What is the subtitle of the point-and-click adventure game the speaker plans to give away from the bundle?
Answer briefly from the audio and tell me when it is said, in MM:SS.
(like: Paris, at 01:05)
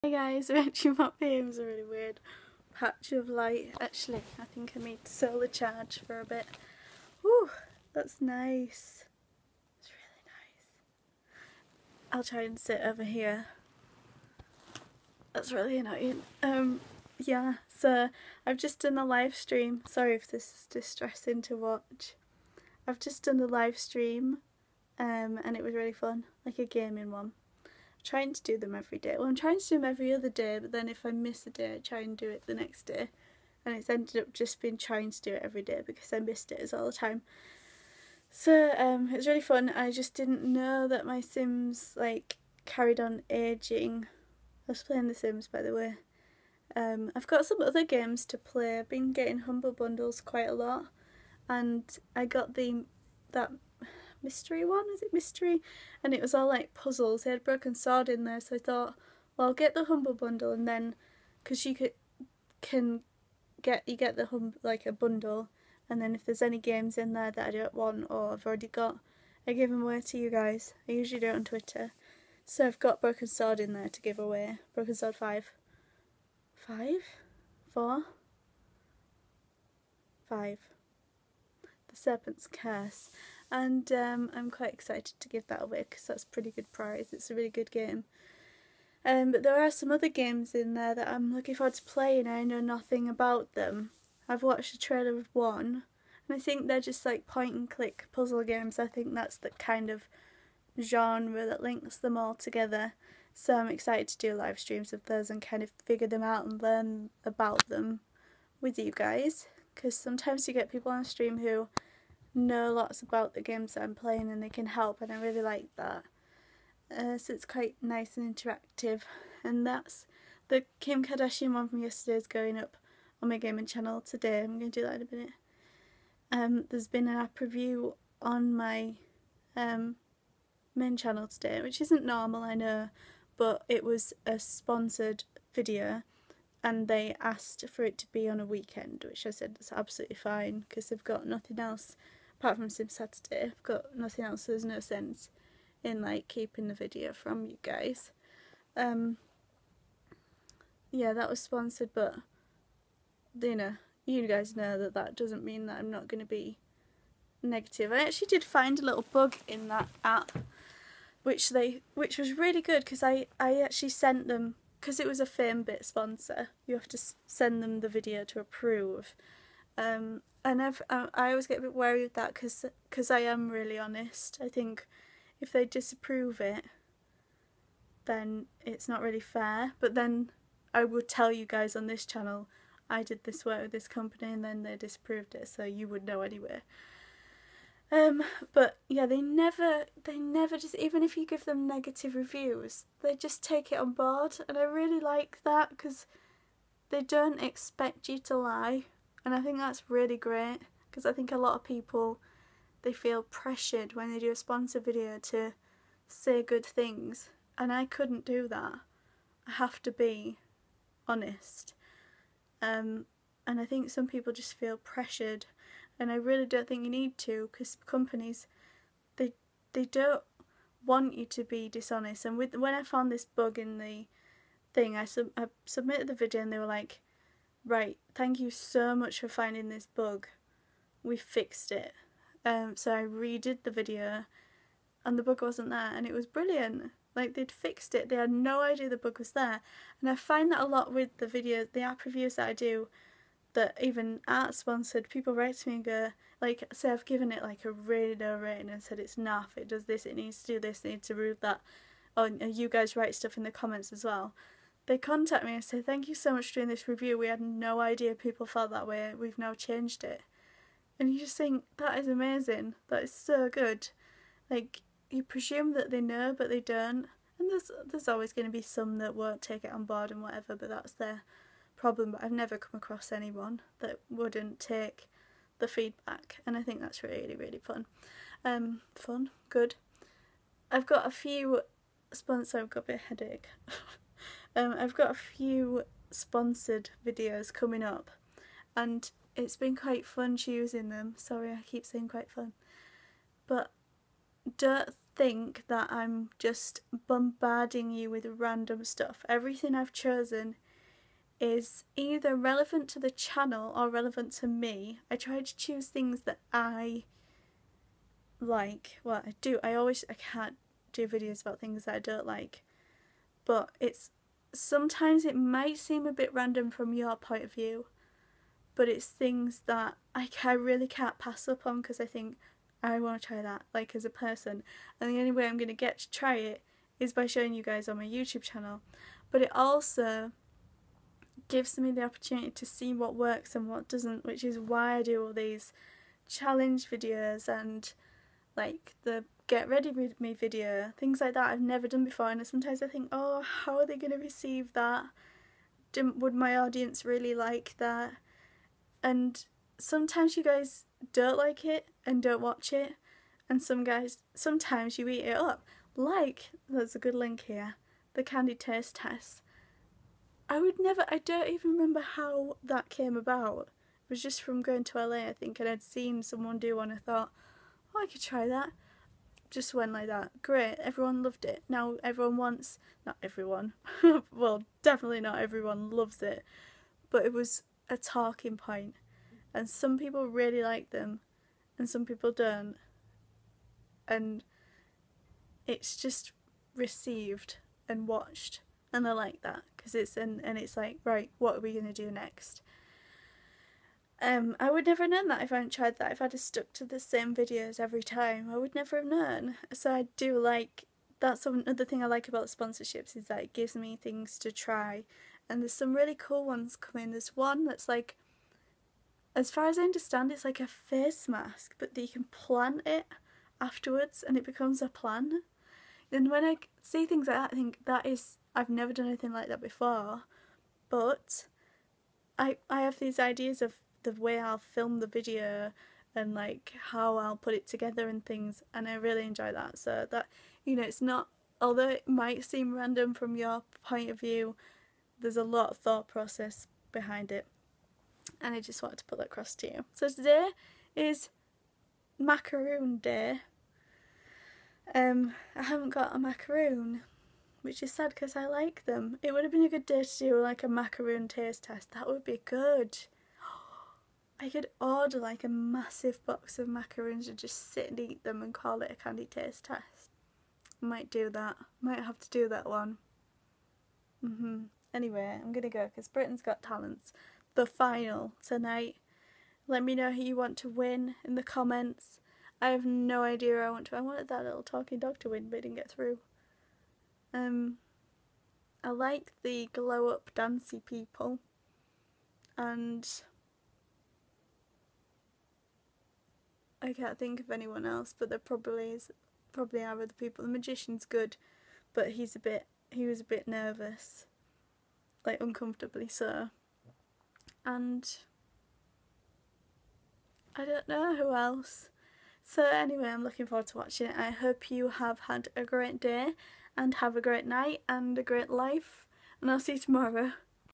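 The Serpent's Curse, at 01:21.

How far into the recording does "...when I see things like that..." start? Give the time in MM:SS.
06:56.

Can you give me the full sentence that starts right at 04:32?
But I've never come across anyone that wouldn't take the feedback.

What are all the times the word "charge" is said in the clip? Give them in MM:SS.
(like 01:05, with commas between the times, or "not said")
00:05.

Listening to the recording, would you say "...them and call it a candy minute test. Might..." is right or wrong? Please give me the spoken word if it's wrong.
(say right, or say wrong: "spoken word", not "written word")
wrong: "taste", not "minute".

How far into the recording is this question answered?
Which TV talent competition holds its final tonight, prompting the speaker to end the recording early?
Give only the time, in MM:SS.
07:46.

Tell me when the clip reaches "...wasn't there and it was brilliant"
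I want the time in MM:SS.
03:55.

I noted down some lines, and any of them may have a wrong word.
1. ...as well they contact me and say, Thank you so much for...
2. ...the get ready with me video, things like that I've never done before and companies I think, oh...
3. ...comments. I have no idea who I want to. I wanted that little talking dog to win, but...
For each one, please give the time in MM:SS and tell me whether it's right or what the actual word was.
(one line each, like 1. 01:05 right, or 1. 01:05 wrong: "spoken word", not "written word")
1. 04:13 right
2. 05:39 wrong: "sometimes", not "companies"
3. 07:51 right.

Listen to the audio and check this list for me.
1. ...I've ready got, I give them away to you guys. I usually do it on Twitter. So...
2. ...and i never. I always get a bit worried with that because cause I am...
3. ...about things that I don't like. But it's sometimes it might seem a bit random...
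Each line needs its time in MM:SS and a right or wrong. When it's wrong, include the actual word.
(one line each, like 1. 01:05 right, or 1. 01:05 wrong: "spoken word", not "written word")
1. 01:08 wrong: "already", not "ready"
2. 02:50 right
3. 05:11 right.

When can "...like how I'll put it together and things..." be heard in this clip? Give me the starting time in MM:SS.
07:06.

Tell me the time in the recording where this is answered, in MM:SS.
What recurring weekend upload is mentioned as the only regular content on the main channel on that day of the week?
02:22.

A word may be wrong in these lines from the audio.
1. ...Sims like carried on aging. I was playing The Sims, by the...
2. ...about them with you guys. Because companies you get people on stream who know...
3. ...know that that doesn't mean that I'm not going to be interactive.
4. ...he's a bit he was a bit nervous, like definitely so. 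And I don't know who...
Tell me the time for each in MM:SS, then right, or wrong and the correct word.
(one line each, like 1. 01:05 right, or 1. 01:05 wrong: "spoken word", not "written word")
1. 00:41 right
2. 01:47 wrong: "sometimes", not "companies"
3. 02:34 wrong: "negative", not "interactive"
4. 08:12 wrong: "uncomfortably", not "definitely".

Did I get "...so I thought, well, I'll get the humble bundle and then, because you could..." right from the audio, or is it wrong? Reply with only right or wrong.
right.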